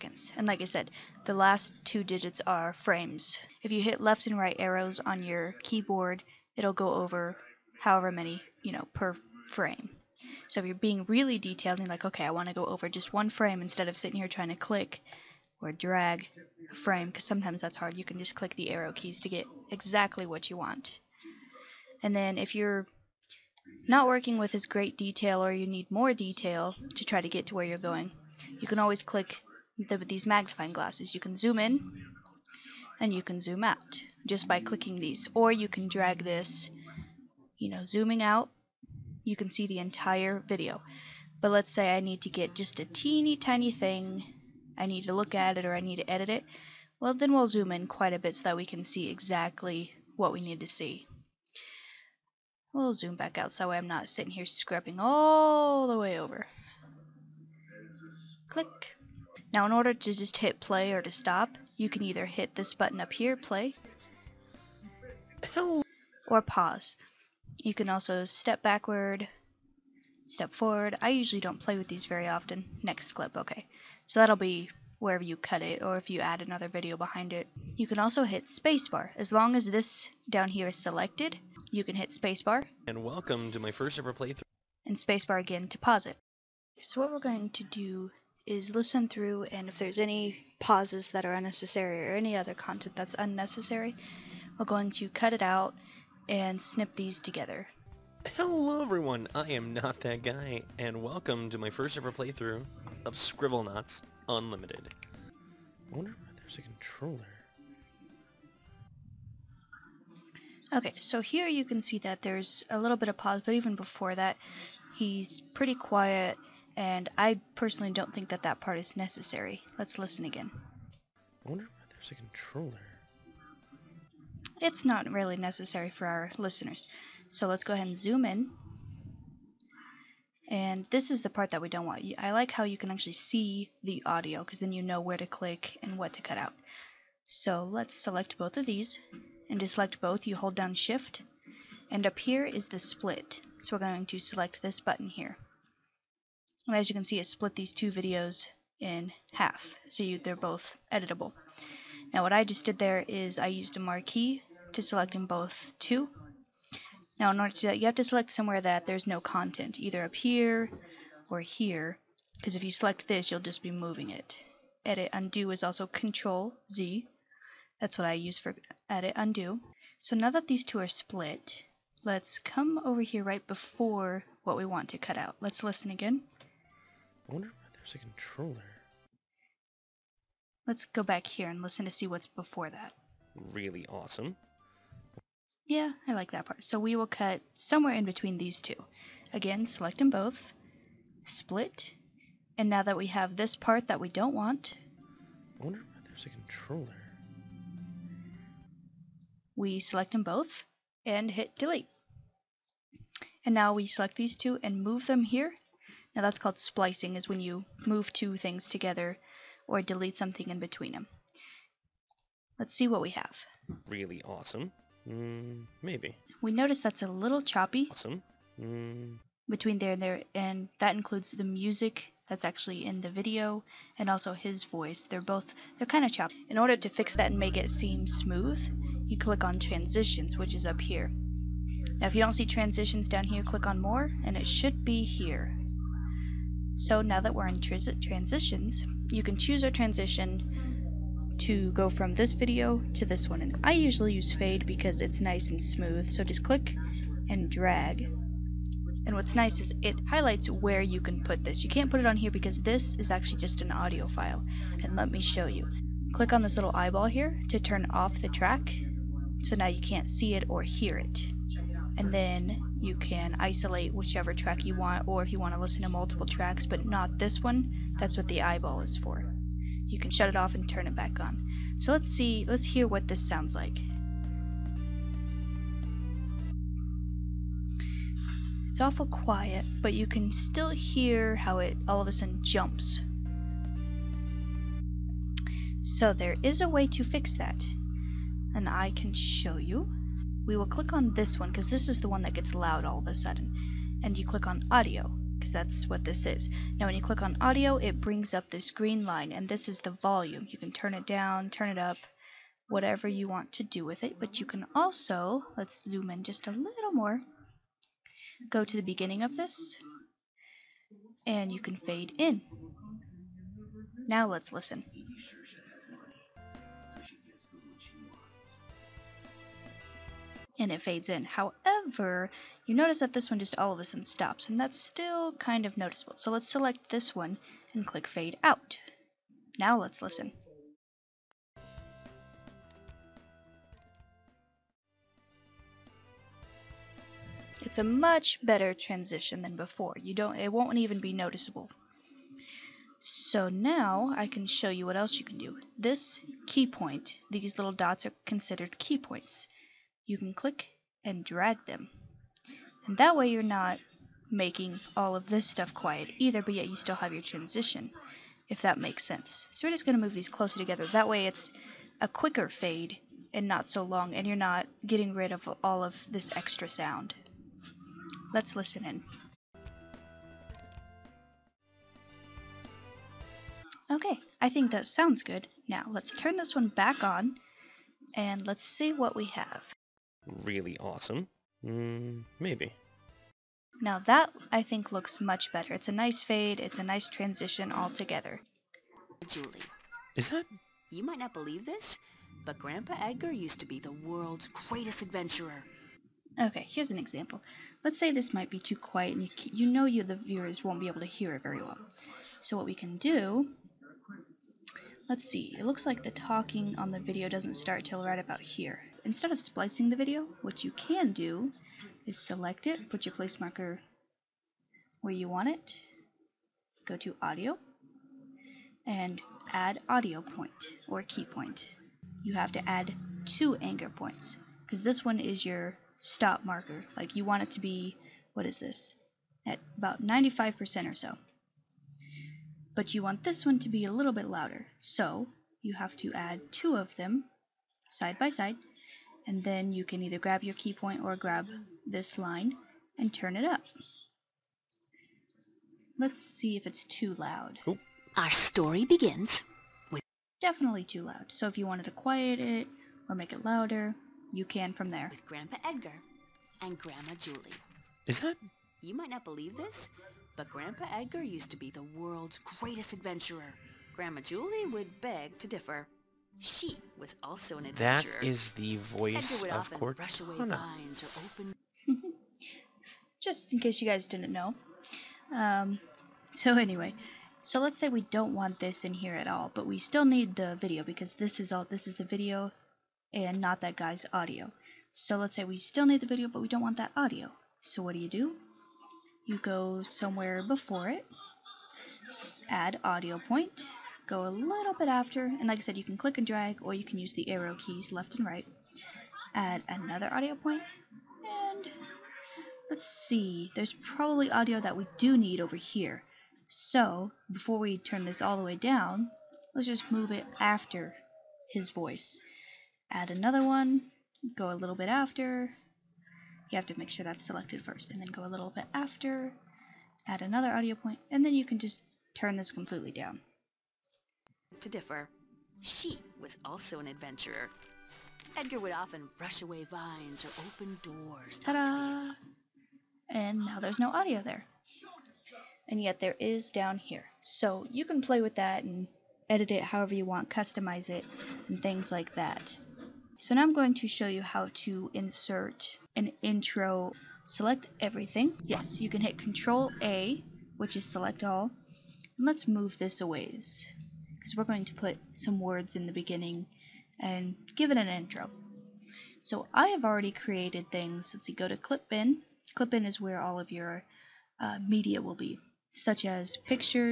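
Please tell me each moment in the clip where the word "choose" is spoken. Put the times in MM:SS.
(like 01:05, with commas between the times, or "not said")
03:59.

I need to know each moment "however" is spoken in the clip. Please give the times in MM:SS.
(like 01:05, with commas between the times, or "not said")
00:07, 05:21, 08:59.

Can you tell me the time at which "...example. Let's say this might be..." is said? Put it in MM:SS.
06:36.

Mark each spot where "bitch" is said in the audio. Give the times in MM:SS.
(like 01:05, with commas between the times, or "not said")
not said.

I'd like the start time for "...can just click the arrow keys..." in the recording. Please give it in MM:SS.
00:18.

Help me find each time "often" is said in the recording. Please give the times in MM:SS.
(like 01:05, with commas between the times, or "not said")
01:12, 08:48.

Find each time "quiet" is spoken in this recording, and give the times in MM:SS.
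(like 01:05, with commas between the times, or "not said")
01:55, 04:39, 05:55, 06:38, 07:31.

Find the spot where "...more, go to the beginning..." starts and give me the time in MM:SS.
05:06.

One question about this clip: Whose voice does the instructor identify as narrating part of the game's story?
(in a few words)
Cortana.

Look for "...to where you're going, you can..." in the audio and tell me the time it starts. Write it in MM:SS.
00:27.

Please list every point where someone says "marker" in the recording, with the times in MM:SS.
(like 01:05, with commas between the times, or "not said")
06:53, 07:06.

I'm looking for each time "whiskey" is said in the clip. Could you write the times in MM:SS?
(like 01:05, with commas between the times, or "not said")
not said.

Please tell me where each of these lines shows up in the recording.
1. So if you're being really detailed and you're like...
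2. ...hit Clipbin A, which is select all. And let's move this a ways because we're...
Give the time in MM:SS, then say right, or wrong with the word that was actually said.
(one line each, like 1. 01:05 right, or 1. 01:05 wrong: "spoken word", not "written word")
1. 00:10 right
2. 09:09 wrong: "Control", not "Clipbin".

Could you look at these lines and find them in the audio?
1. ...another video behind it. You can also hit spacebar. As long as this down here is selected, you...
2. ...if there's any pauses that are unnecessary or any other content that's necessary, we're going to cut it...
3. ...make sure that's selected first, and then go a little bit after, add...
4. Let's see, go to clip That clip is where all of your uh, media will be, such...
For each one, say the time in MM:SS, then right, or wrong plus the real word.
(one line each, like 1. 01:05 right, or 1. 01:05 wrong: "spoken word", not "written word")
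1. 01:16 right
2. 01:29 wrong: "unnecessary", not "necessary"
3. 08:36 right
4. 09:21 wrong: "Clipbin", not "That".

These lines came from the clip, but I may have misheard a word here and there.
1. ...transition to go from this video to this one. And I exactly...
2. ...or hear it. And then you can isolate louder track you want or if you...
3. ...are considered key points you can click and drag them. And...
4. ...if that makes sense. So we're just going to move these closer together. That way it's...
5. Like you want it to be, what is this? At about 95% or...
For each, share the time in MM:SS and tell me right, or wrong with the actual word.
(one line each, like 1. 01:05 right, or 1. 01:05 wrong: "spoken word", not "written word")
1. 03:59 wrong: "usually", not "exactly"
2. 04:20 wrong: "whichever", not "louder"
3. 05:48 right
4. 05:58 right
5. 07:06 right.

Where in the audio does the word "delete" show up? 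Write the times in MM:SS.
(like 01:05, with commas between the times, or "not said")
03:21, 03:29.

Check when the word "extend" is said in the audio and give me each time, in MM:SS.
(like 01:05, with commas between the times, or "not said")
not said.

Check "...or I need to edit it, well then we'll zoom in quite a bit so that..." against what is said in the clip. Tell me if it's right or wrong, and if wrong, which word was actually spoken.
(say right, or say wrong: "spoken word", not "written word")
right.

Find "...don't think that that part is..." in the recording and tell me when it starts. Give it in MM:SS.
01:57.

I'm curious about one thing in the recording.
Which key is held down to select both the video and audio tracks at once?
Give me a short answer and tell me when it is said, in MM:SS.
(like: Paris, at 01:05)
Shift, at 02:20.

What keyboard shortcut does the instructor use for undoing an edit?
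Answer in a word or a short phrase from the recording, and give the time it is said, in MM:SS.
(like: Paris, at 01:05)
Control Z, at 02:45.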